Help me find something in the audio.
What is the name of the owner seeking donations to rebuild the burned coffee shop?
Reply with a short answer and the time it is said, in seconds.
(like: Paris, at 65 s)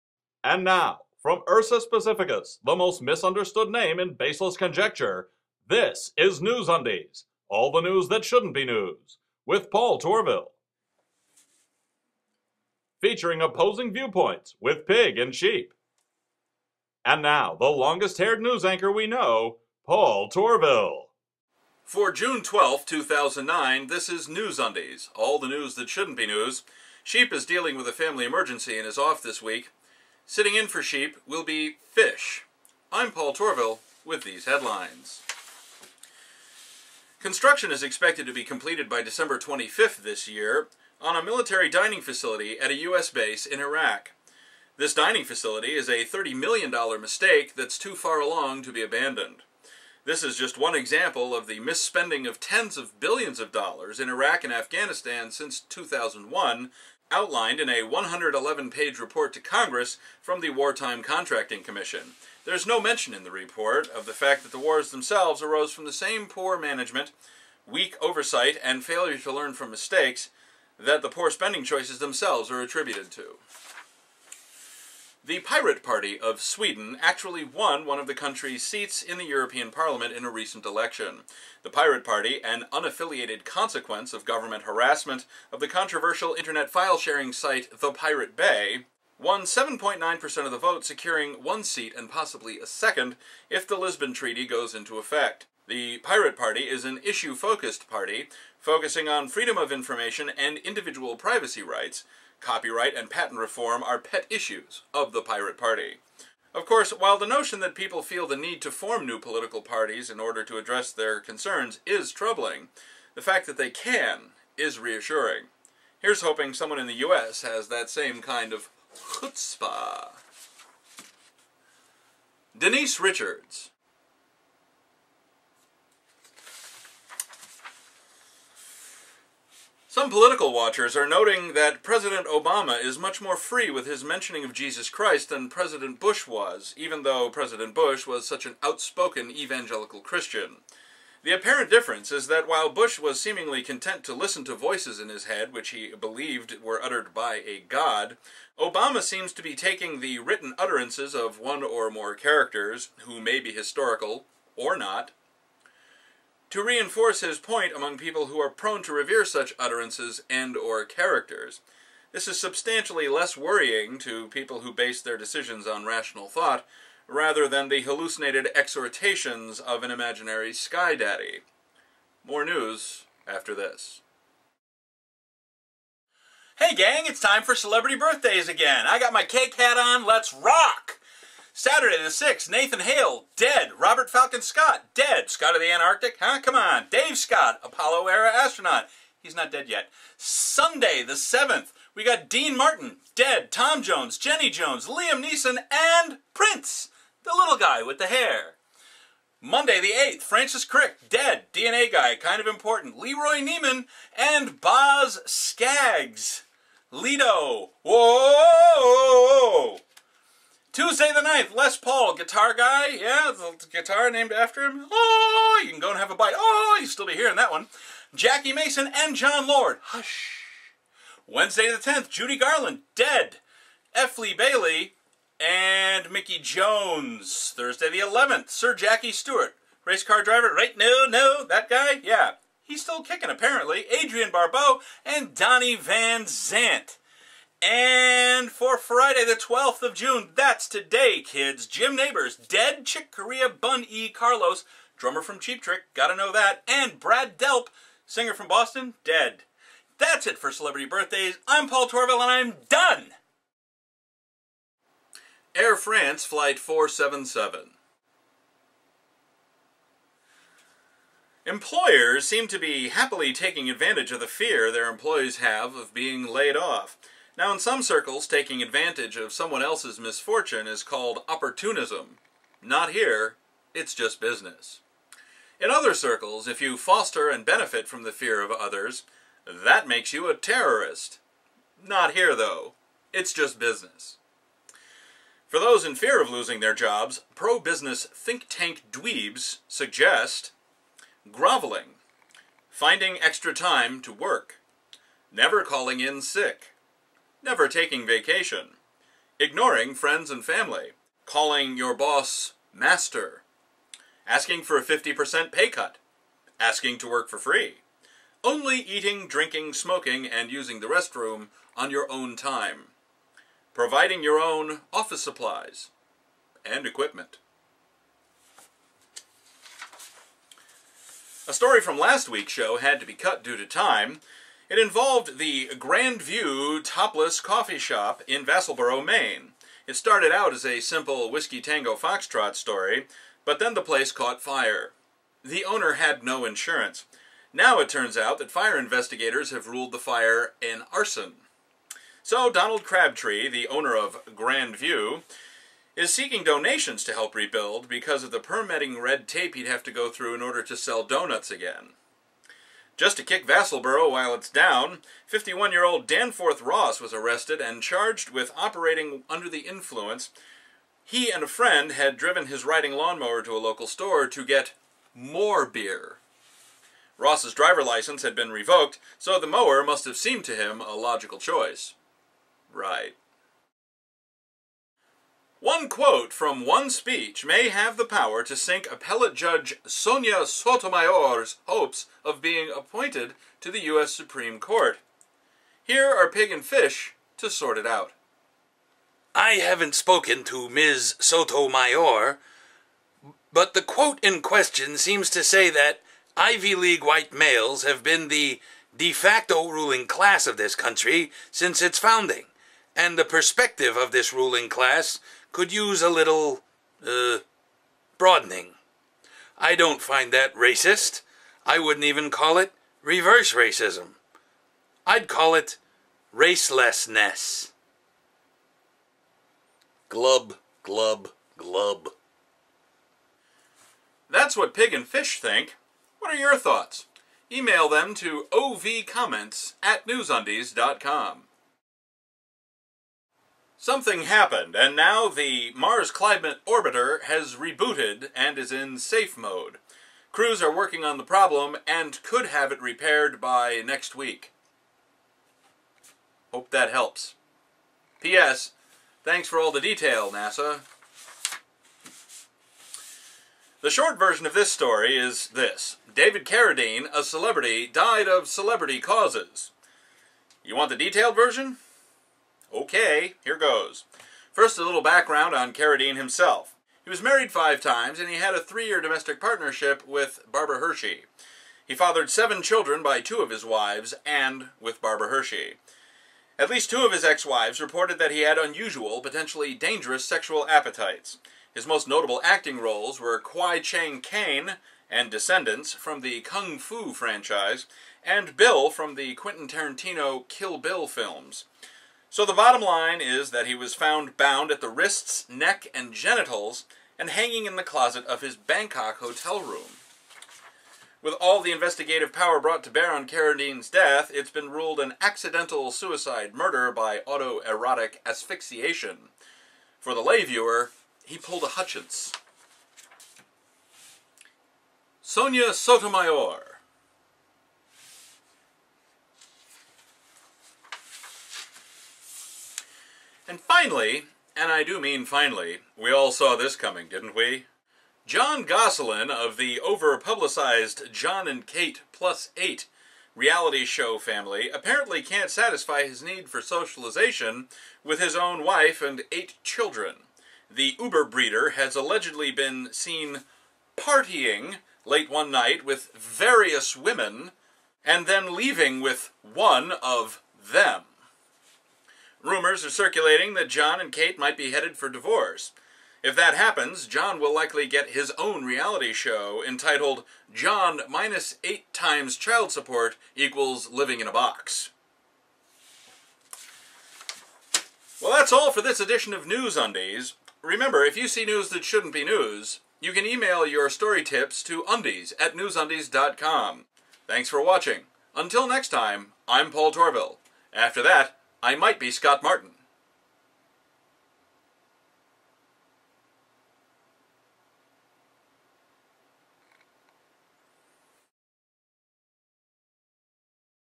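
Donald Crabtree, at 342 s.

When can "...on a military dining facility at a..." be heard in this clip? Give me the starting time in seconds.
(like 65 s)
41 s.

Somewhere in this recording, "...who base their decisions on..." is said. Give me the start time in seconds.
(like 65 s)
164 s.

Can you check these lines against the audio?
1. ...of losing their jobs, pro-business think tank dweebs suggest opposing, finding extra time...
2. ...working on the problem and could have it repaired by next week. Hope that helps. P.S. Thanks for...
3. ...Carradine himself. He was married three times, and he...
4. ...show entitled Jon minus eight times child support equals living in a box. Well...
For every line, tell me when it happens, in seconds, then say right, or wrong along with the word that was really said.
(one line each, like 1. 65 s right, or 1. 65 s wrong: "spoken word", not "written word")
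1. 286 s wrong: "groveling", not "opposing"
2. 440 s right
3. 465 s wrong: "five", not "three"
4. 559 s right.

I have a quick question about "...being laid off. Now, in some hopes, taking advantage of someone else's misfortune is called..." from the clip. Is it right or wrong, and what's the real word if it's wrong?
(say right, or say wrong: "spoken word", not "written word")
wrong: "circles", not "hopes".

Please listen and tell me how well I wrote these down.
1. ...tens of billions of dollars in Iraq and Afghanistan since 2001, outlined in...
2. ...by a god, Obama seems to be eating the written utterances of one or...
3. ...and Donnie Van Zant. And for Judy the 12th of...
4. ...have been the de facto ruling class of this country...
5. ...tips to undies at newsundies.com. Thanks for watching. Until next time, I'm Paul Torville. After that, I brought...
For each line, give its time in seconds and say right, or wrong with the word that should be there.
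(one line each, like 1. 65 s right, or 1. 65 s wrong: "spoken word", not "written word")
1. 52 s right
2. 147 s wrong: "taking", not "eating"
3. 235 s wrong: "Friday", not "Judy"
4. 397 s right
5. 574 s wrong: "might", not "brought".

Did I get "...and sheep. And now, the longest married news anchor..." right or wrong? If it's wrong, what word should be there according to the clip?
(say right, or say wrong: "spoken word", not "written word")
wrong: "haired", not "married".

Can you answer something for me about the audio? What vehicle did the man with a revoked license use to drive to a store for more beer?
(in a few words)
Riding lawnmower.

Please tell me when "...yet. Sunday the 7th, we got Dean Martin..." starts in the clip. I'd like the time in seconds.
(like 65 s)
189 s.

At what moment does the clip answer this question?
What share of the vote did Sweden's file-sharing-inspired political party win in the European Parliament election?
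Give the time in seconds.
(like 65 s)
89 s.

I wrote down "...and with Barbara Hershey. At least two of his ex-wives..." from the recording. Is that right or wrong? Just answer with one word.
right.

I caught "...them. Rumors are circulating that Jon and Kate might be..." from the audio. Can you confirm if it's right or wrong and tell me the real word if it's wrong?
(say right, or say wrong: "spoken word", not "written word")
right.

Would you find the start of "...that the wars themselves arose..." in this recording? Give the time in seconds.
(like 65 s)
64 s.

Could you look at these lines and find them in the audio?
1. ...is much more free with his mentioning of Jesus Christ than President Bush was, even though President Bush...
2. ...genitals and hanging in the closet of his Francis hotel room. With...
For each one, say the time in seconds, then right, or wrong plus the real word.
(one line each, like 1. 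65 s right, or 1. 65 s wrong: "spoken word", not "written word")
1. 132 s right
2. 496 s wrong: "Bangkok", not "Francis".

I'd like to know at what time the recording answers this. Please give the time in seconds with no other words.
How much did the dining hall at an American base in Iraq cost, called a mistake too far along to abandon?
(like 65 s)
46 s.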